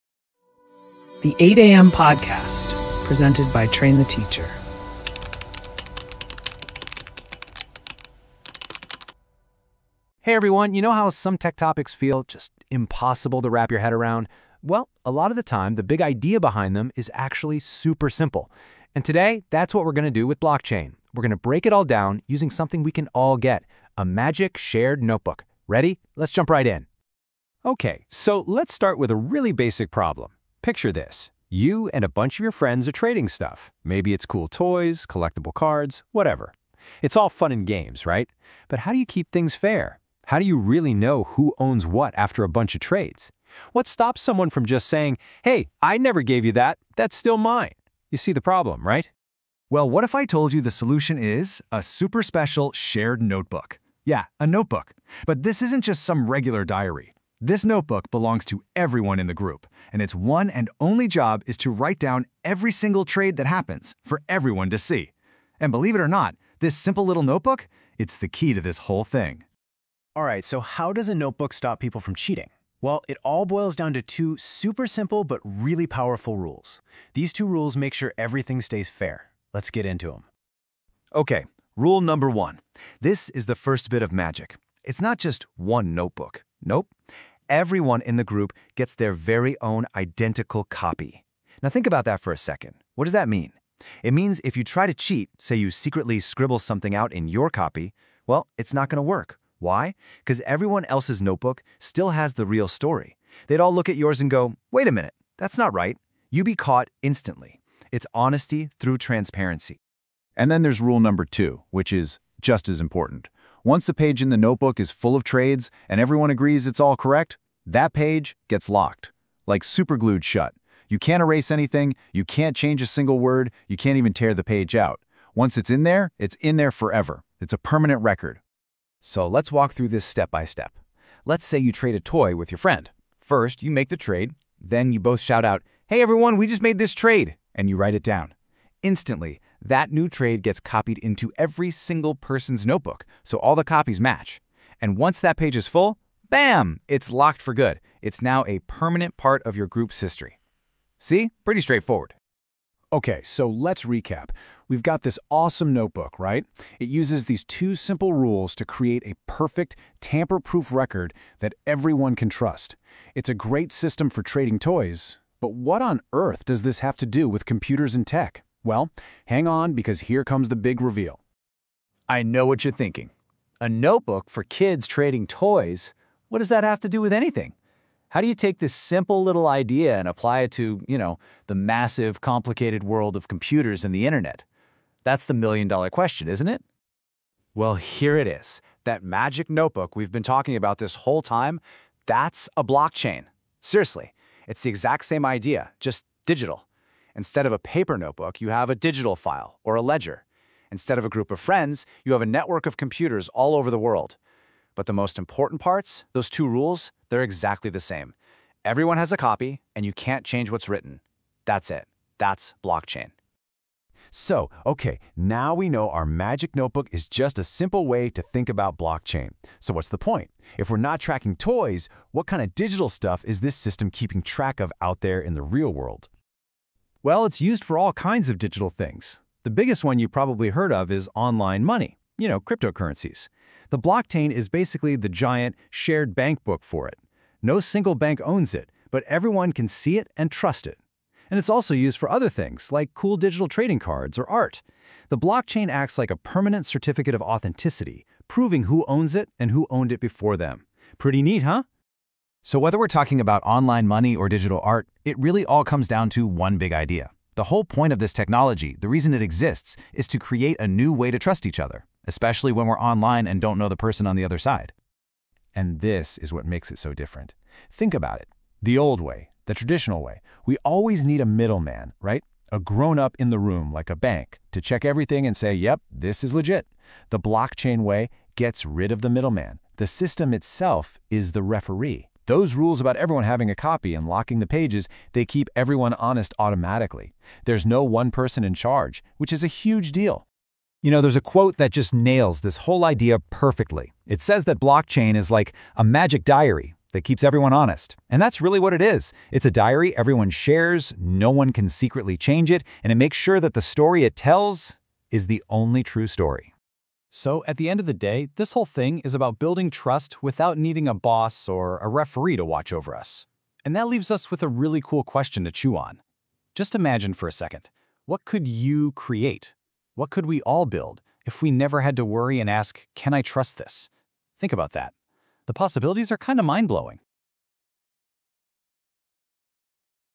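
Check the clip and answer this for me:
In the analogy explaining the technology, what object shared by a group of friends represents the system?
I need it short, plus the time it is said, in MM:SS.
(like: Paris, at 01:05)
magic shared notebook, at 00:24.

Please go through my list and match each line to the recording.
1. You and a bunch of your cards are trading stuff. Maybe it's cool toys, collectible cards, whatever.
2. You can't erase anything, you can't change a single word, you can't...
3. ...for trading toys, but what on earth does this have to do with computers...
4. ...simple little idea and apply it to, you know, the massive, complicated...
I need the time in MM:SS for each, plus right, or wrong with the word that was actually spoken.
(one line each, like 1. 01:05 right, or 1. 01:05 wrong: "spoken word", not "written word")
1. 00:31 wrong: "friends", not "cards"
2. 02:00 right
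3. 02:44 right
4. 02:58 right.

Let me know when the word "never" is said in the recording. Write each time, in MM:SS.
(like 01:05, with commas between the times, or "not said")
00:45, 05:21.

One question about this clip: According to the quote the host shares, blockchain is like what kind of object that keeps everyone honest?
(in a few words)
magic diary.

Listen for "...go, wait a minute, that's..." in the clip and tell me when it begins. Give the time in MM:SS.
01:44.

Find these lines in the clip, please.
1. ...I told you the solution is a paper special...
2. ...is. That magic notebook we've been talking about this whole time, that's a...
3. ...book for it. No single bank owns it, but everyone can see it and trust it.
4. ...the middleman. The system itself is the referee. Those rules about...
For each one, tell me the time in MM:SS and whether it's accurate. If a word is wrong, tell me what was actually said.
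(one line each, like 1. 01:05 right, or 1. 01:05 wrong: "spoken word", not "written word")
1. 00:50 wrong: "super", not "paper"
2. 03:08 right
3. 03:56 right
4. 04:39 right.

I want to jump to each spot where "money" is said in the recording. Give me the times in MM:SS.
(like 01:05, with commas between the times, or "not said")
03:51, 04:13.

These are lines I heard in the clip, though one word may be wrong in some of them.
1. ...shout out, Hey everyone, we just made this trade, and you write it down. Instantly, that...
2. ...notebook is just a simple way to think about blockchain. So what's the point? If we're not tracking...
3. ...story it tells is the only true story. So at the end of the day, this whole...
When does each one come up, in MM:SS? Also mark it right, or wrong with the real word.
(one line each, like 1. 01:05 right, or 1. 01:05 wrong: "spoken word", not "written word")
1. 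02:15 right
2. 03:36 right
3. 05:03 right.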